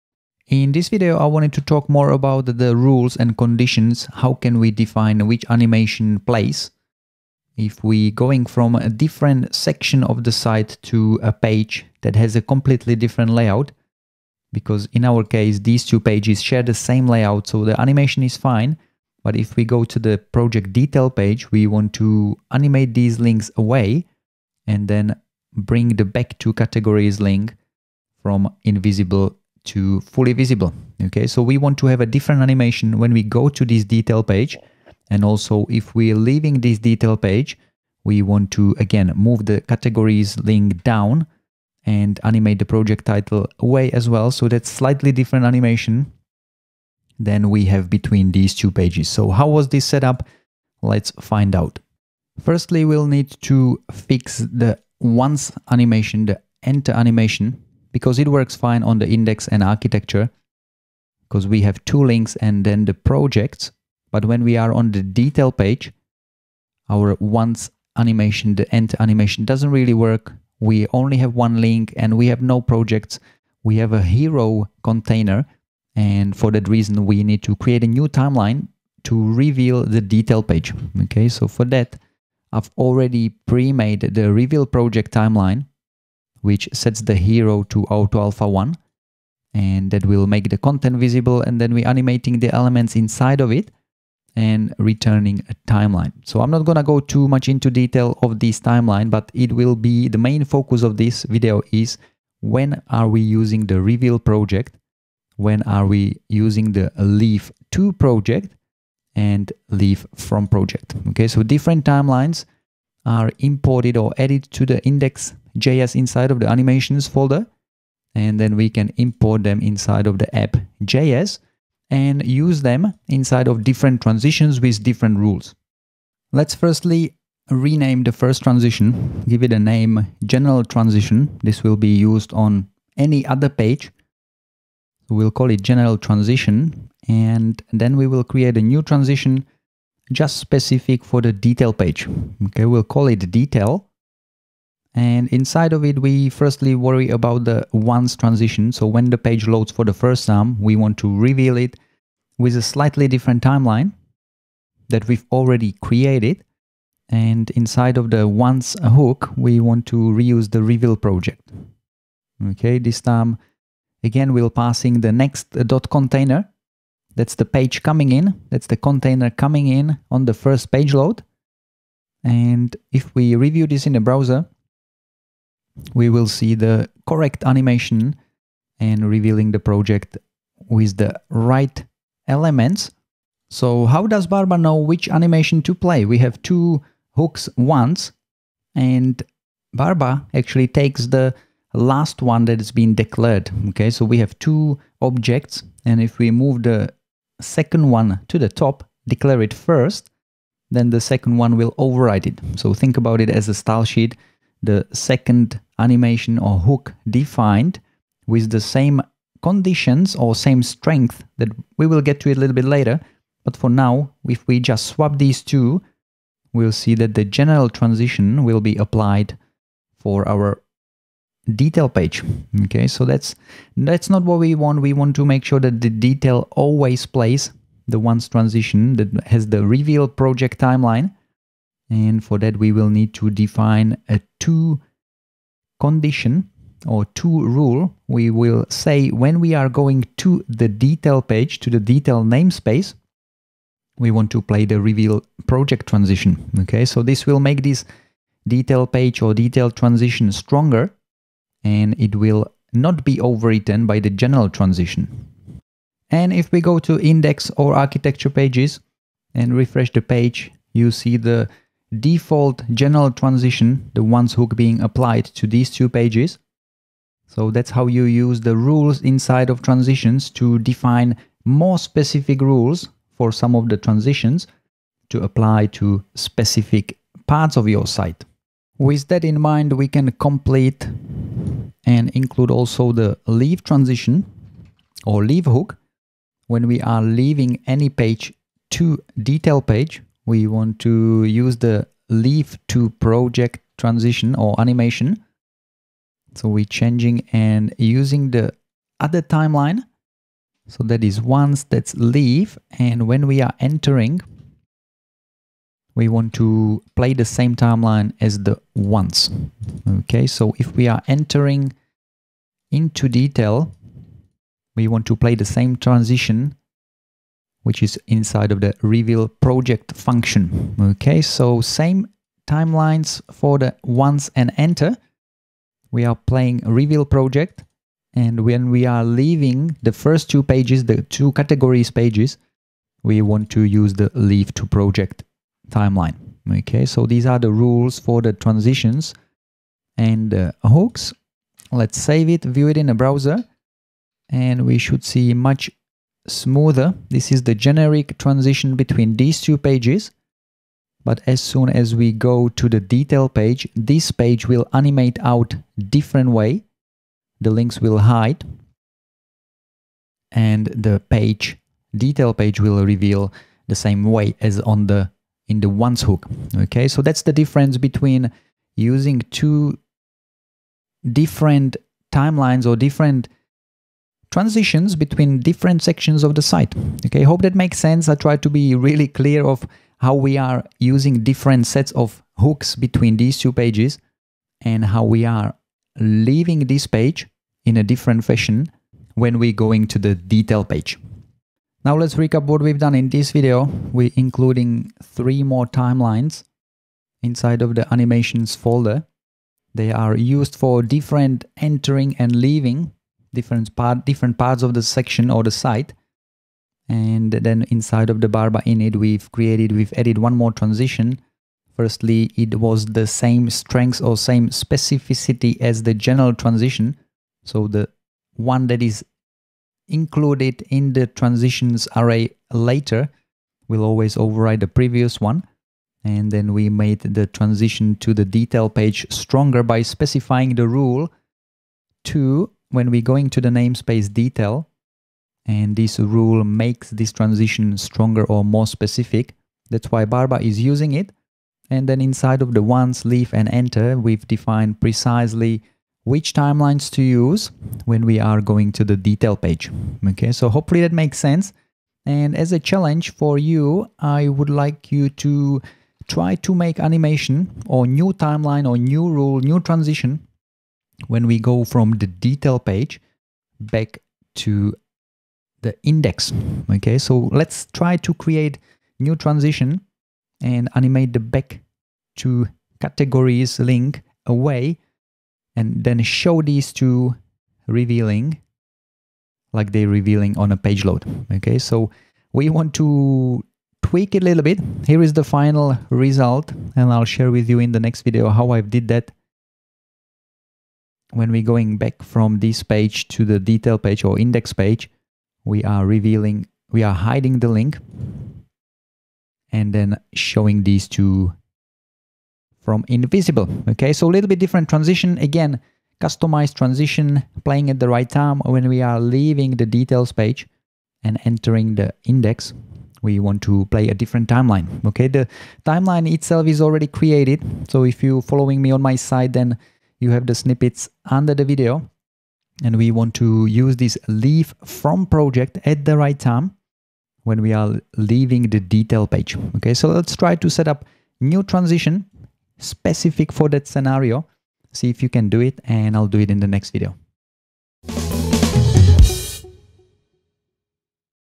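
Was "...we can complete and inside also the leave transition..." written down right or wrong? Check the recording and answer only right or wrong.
wrong.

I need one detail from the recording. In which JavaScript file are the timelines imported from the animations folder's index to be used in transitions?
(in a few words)
app.js.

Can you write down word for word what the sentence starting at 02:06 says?
Let's firstly rename the first transition, give it a name general transition.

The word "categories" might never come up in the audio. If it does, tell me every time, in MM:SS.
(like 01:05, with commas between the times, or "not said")
00:26, 00:39, 05:31, 07:52.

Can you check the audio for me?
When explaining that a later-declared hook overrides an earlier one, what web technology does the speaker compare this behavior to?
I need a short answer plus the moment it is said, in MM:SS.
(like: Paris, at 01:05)
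style sheet, at 03:23.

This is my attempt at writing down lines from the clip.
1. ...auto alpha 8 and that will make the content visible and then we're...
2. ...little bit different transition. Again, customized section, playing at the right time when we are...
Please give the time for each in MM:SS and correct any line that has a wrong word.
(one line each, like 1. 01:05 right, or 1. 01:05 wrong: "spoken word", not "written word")
1. 01:27 wrong: "1", not "8"
2. 08:24 wrong: "transition", not "section".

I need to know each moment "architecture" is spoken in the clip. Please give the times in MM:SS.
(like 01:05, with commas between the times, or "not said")
00:59, 04:17.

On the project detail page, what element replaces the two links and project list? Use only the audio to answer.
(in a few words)
hero container.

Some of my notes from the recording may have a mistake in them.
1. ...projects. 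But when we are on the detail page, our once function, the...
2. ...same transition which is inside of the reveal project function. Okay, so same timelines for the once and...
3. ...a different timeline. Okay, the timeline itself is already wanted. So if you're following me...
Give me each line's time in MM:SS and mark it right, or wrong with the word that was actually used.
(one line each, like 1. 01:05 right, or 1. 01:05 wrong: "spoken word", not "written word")
1. 01:02 wrong: "animation", not "function"
2. 05:15 right
3. 08:33 wrong: "created", not "wanted".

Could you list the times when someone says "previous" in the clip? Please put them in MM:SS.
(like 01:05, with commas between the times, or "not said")
07:04.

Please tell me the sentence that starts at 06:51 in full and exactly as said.
Firstly, it was the same strength or same specificity as the general transition.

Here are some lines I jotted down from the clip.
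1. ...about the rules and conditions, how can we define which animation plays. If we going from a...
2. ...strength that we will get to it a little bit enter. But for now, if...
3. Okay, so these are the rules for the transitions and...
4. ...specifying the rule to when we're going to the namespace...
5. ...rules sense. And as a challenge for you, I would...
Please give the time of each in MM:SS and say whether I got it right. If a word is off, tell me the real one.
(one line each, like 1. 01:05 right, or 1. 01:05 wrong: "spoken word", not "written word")
1. 00:02 right
2. 03:30 wrong: "later", not "enter"
3. 05:36 right
4. 07:09 right
5. 07:30 wrong: "makes", not "rules".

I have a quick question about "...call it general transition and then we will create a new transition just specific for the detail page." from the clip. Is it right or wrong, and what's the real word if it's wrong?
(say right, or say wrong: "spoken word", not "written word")
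right.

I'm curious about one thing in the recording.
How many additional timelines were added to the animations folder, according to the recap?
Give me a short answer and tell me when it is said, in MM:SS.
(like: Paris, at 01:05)
3, at 06:35.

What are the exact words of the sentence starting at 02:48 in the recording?
That's the container coming in on the first page load.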